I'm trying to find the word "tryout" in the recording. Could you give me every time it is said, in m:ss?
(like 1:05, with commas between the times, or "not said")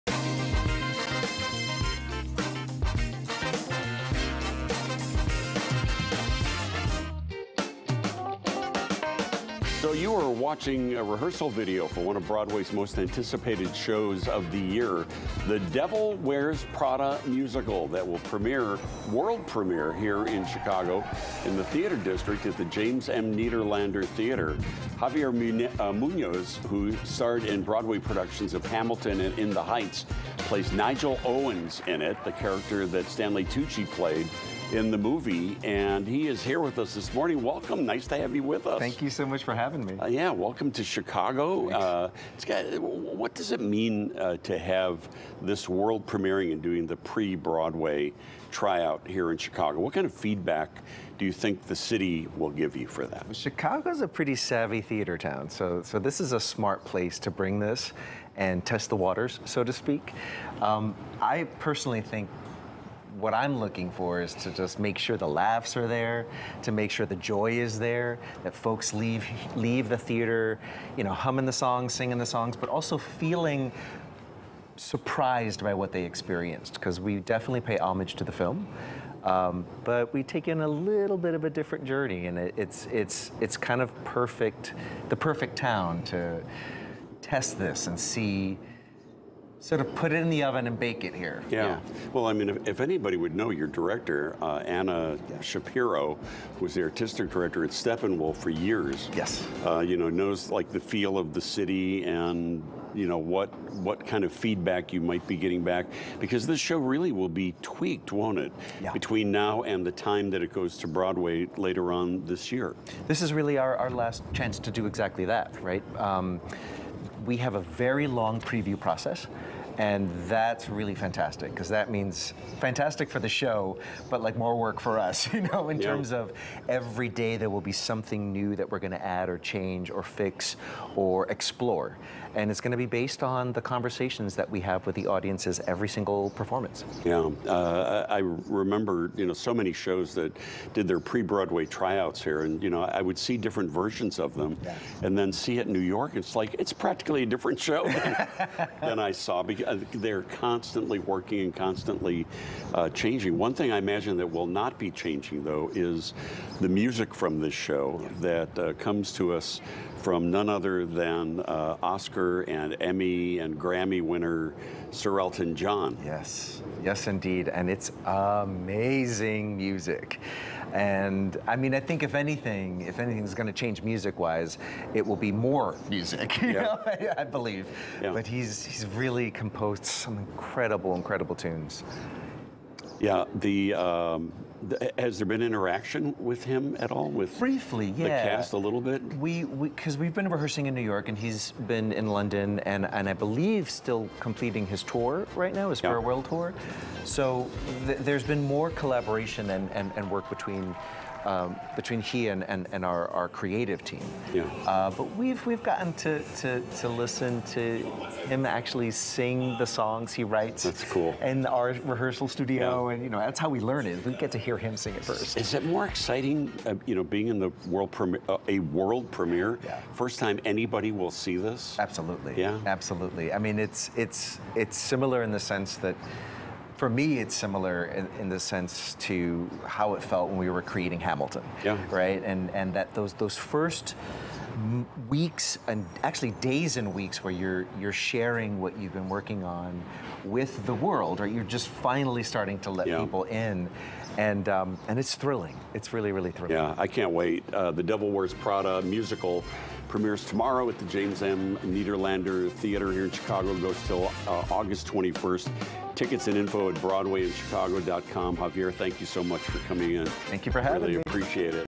0:48, 2:21.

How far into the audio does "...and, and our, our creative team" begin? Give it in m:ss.
3:22.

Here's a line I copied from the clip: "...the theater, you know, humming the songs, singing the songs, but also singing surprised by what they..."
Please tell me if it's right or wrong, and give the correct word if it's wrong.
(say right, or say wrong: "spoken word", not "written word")
wrong: "feeling", not "singing".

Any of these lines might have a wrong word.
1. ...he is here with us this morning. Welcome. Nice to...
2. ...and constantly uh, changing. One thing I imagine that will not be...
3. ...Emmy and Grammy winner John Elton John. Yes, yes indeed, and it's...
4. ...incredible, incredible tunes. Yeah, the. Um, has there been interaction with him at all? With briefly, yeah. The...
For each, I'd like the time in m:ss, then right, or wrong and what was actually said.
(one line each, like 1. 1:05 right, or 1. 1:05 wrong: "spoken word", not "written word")
1. 0:36 right
2. 2:31 right
3. 2:42 wrong: "Sir", not "John"
4. 3:00 right.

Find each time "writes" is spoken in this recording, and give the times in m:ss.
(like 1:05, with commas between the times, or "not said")
3:30.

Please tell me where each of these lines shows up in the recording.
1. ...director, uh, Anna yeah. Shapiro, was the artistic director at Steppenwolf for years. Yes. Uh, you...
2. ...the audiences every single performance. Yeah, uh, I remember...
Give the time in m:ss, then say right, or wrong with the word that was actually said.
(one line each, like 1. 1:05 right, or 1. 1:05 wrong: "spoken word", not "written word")
1. 1:33 right
2. 2:14 right.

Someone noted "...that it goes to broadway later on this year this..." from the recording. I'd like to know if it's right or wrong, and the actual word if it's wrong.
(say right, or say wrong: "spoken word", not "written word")
right.